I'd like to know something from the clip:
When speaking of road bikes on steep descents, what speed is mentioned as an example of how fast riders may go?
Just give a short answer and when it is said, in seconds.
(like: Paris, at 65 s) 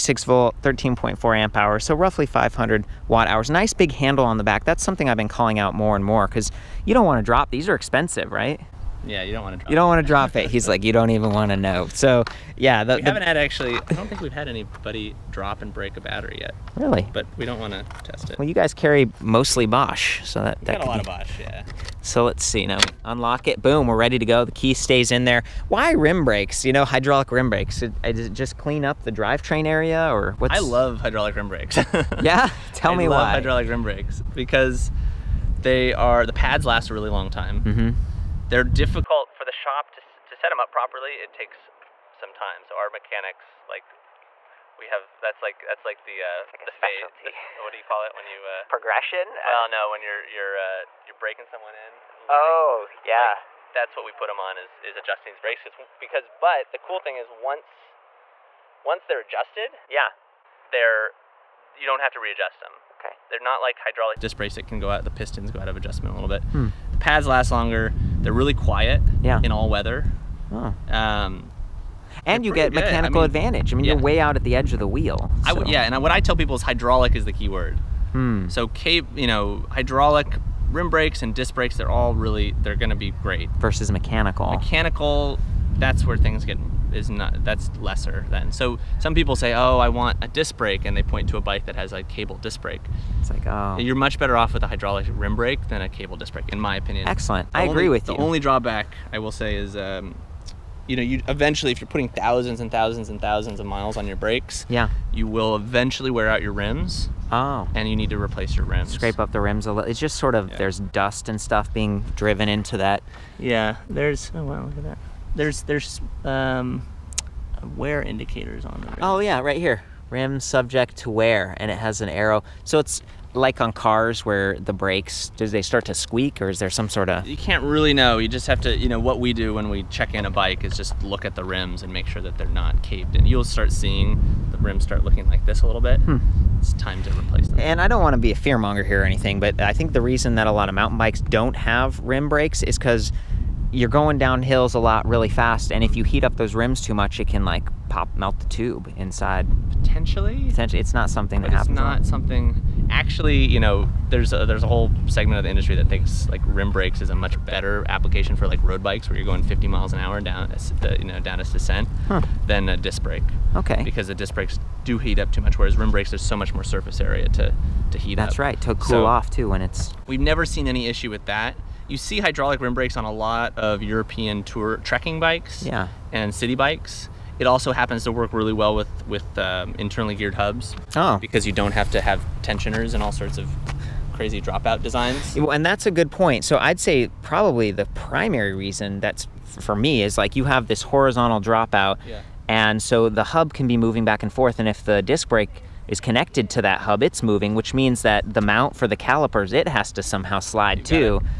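50 miles an hour, at 159 s.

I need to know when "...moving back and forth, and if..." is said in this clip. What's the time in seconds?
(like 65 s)
193 s.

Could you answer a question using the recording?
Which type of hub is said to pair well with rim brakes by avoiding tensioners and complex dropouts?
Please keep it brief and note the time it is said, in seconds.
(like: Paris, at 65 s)
internally geared hubs, at 179 s.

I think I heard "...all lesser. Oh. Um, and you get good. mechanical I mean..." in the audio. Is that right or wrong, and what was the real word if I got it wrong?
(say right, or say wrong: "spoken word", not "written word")
wrong: "weather", not "lesser".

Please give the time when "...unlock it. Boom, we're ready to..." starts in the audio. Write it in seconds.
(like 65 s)
23 s.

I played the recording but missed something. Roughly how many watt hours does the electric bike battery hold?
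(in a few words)
500 watt hours.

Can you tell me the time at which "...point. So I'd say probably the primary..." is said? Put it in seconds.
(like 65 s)
186 s.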